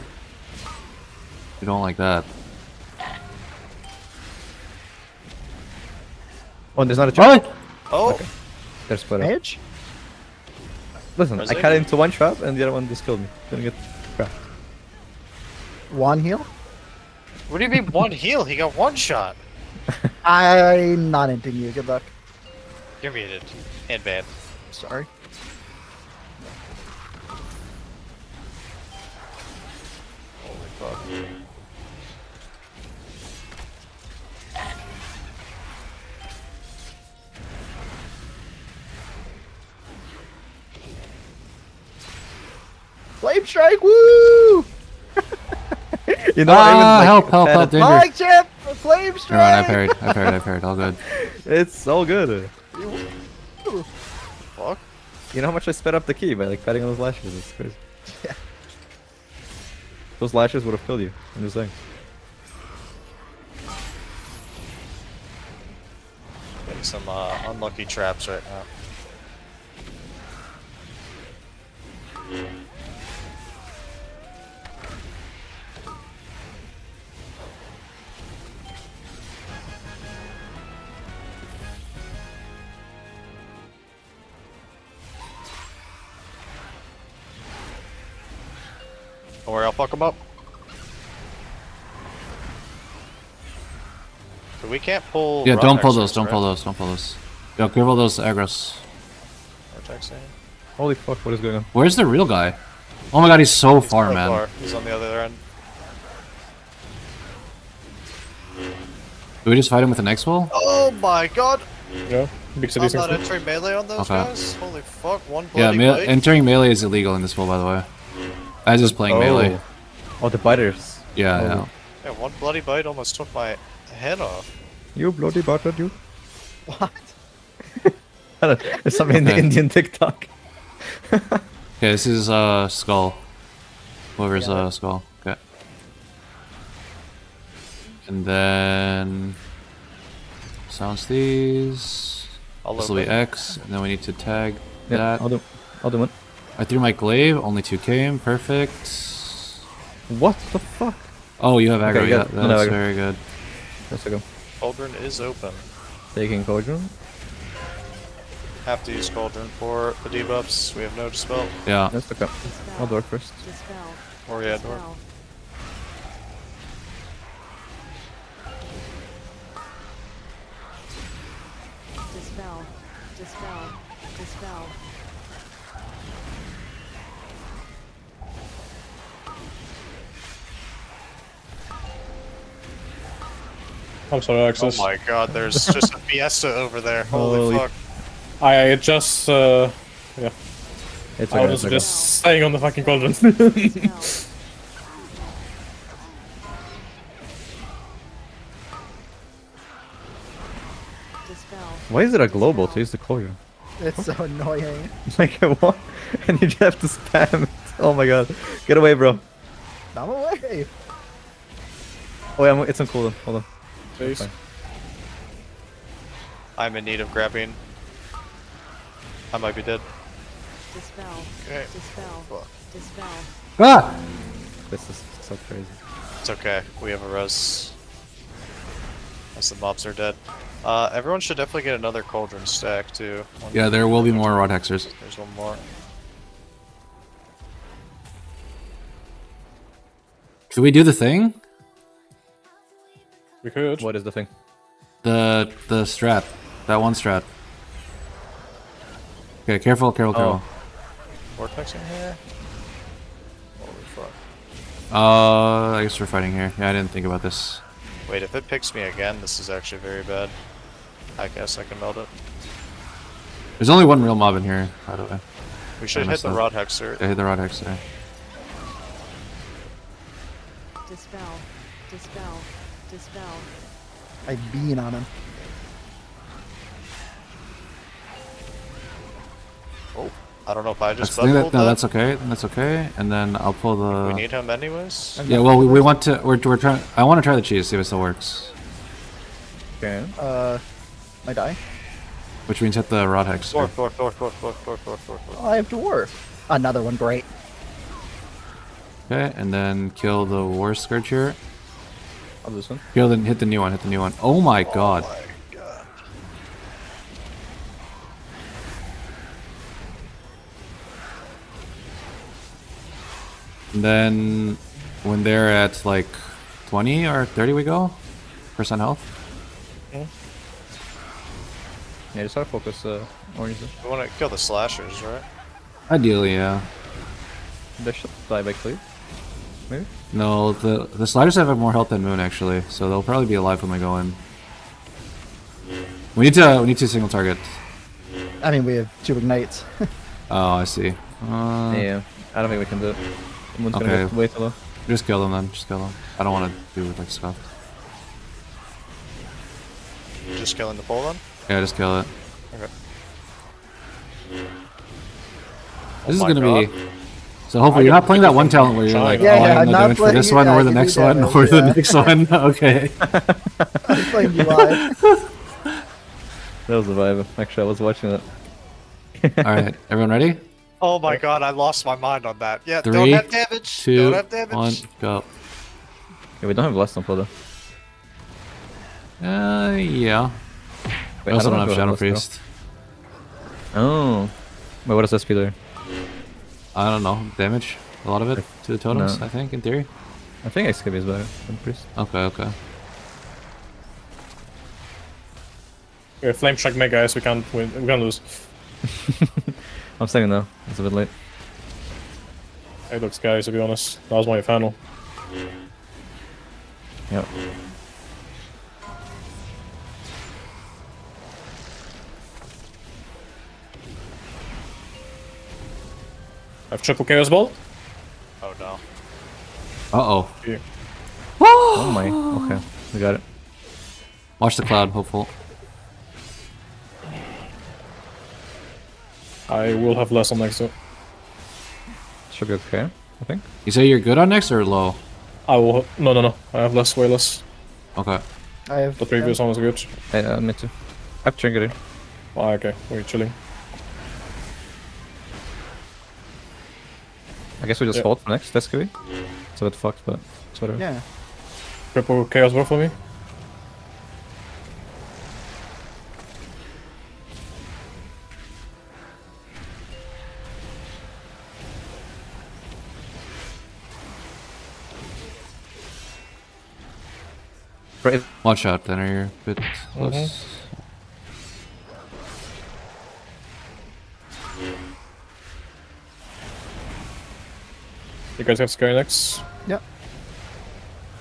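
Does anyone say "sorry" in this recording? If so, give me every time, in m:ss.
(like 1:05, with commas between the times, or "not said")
0:24, 3:04.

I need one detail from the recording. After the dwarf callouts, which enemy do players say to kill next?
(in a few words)
Warscourge.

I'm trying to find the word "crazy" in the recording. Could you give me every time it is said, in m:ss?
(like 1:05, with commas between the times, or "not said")
0:57, 3:45.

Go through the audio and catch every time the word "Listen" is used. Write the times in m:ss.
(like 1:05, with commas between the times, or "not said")
0:11.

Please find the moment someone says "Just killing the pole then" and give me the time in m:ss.
5:50.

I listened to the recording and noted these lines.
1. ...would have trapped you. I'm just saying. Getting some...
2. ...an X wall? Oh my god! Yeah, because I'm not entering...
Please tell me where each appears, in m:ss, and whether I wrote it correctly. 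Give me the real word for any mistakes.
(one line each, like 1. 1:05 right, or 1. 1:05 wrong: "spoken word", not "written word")
1. 1:00 wrong: "killed", not "trapped"
2. 1:49 right.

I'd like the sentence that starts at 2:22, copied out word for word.
This will be X, and then we need to tag yeah, that.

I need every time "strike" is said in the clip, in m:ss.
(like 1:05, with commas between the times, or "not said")
0:43, 0:49, 6:36.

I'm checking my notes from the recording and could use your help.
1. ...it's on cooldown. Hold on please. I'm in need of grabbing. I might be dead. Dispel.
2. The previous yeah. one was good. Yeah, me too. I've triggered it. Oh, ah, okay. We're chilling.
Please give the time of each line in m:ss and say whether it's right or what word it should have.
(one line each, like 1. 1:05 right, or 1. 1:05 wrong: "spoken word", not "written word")
1. 3:32 right
2. 7:18 right.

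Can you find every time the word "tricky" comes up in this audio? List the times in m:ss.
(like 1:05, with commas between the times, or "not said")
not said.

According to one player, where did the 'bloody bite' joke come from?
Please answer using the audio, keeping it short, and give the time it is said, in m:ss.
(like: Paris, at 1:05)
Indian TikTok, at 2:09.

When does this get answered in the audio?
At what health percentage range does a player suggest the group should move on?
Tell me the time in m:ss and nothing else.
5:16.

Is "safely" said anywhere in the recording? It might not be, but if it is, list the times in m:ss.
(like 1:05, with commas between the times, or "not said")
not said.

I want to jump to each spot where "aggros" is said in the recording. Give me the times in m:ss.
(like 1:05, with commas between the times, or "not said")
1:38, 2:31.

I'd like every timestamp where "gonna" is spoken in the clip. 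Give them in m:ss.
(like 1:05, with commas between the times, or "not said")
0:13, 5:44, 5:56.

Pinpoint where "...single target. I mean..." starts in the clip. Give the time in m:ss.
5:36.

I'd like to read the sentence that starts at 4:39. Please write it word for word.
Oh, I don't know if I just that's, that, No, that's okay.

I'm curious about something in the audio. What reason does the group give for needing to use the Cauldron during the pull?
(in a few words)
No Dispel.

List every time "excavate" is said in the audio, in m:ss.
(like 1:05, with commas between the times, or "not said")
6:30.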